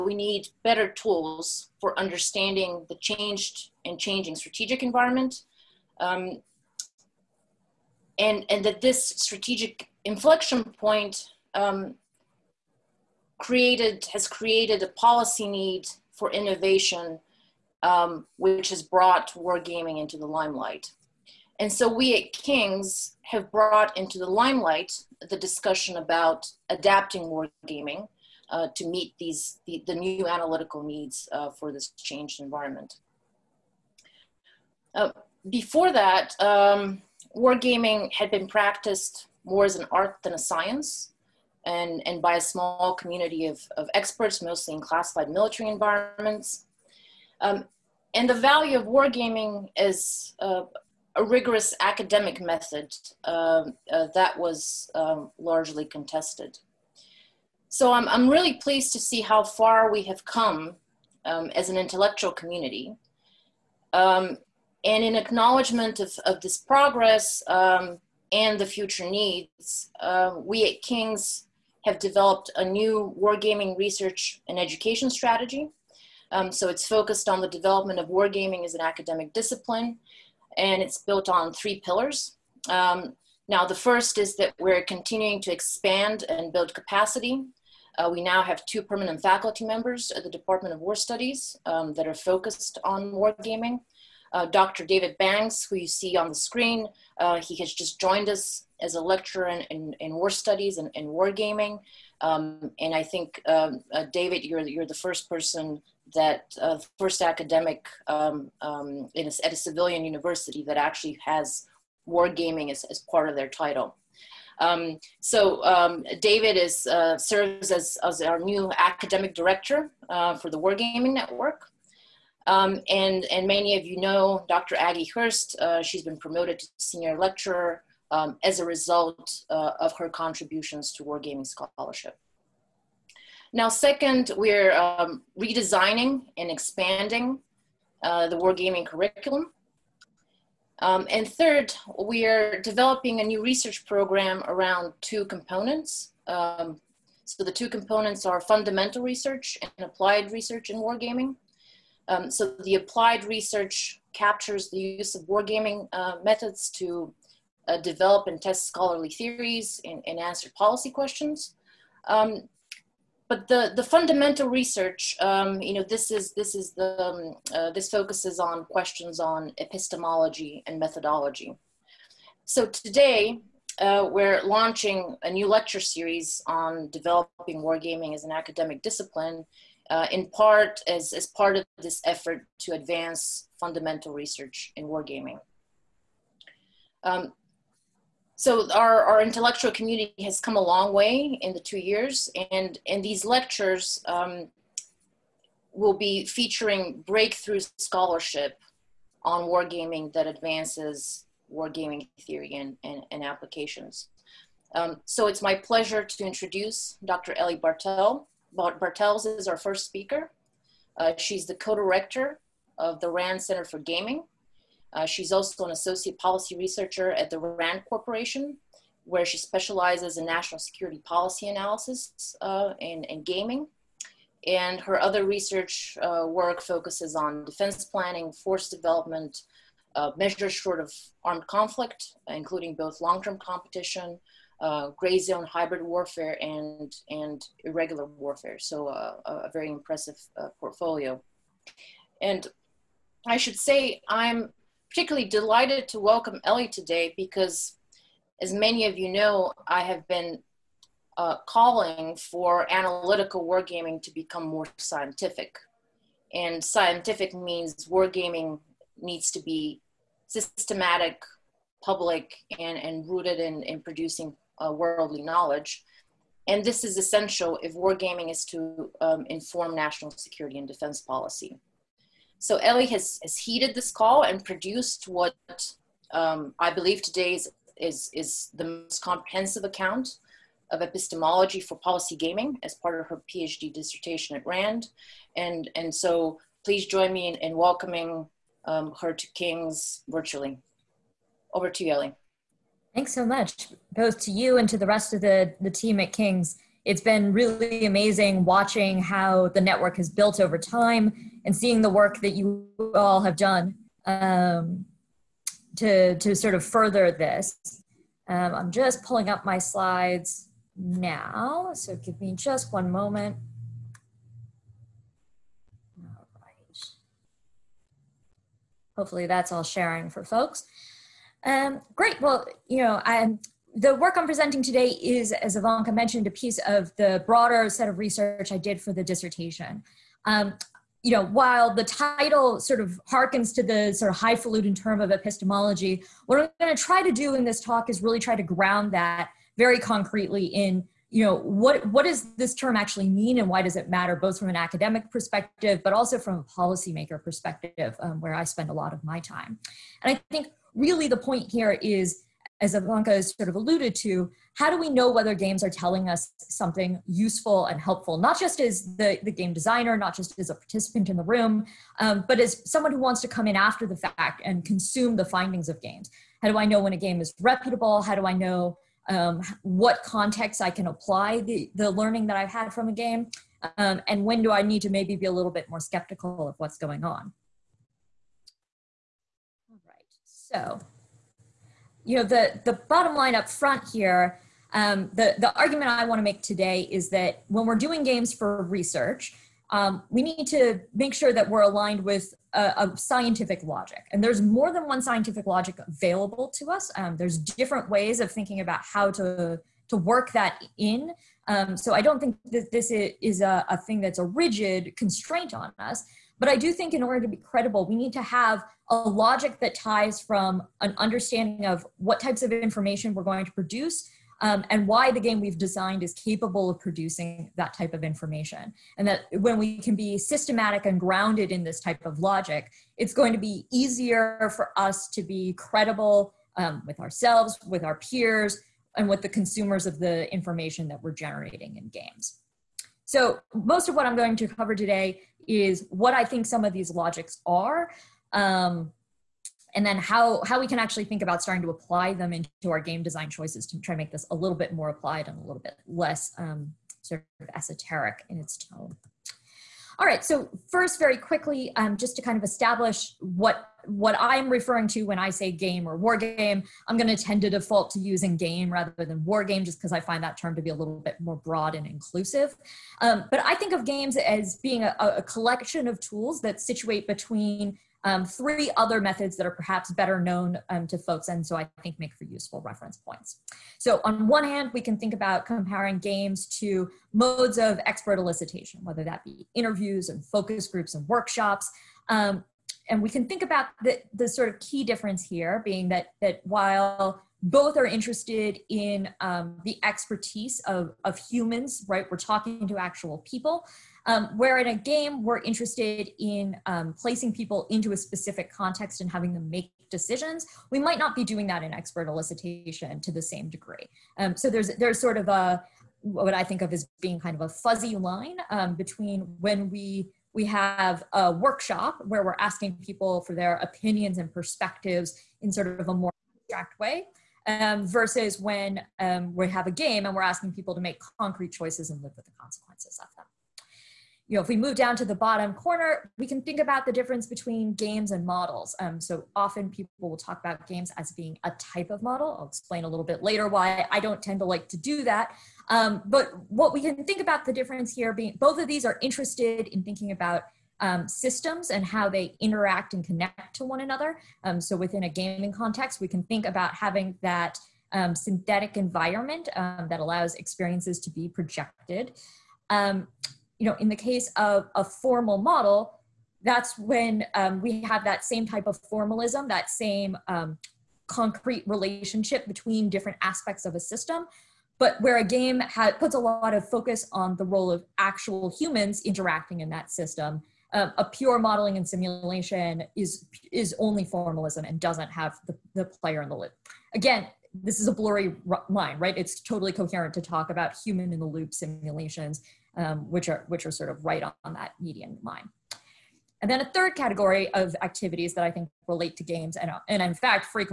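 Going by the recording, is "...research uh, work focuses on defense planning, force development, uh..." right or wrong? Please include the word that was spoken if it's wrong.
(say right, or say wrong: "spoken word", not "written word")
right.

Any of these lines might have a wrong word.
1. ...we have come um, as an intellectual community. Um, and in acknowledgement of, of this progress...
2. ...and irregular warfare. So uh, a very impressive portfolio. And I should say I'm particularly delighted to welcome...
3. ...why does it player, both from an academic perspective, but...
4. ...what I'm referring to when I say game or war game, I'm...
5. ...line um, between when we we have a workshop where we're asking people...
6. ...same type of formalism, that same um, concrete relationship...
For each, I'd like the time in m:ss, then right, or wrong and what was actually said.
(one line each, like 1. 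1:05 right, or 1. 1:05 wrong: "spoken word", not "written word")
1. 0:59 right
2. 3:57 right
3. 5:43 wrong: "matter", not "player"
4. 7:33 right
5. 8:27 right
6. 9:18 right.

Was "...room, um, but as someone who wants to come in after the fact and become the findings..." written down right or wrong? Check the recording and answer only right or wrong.
wrong.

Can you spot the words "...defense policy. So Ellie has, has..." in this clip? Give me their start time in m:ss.
4:30.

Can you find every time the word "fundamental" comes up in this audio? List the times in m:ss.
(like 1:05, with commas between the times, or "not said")
2:28, 2:43, 3:03.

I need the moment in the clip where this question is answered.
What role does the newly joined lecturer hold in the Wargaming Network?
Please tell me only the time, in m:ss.
1:58.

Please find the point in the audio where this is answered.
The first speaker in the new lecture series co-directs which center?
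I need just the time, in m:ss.
3:33.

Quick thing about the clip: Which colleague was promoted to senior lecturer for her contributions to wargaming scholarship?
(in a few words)
Aggie Hirst.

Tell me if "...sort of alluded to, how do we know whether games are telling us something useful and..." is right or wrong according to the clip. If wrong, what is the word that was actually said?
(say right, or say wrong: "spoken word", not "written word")
right.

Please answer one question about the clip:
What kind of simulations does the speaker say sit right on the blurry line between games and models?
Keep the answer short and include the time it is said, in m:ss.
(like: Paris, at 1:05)
Human in the loop, at 9:40.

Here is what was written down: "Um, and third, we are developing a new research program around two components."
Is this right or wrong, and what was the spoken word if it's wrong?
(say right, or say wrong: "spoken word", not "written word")
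right.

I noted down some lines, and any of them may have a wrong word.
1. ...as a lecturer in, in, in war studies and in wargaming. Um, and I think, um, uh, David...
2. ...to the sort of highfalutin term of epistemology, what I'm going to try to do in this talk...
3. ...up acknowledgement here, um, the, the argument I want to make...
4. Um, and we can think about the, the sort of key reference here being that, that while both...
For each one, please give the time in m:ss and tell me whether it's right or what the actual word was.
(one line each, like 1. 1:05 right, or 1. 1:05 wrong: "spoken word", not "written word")
1. 1:38 right
2. 5:33 right
3. 6:23 wrong: "front", not "acknowledgement"
4. 8:02 wrong: "difference", not "reference".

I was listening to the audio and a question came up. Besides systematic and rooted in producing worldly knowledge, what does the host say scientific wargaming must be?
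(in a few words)
Public.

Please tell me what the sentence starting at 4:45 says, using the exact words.
And, and so please join me in, in welcoming um, her to King's virtually.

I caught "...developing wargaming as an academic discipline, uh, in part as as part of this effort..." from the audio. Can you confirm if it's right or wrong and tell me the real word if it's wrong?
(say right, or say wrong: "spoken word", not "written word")
right.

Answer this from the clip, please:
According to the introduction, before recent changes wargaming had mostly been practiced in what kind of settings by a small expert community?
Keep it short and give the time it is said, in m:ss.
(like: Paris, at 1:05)
Classified military environments, at 0:44.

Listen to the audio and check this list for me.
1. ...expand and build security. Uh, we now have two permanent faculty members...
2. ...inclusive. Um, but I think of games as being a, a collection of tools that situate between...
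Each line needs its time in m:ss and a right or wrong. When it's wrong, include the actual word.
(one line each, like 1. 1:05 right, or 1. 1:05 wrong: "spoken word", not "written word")
1. 1:25 wrong: "capacity", not "security"
2. 7:41 right.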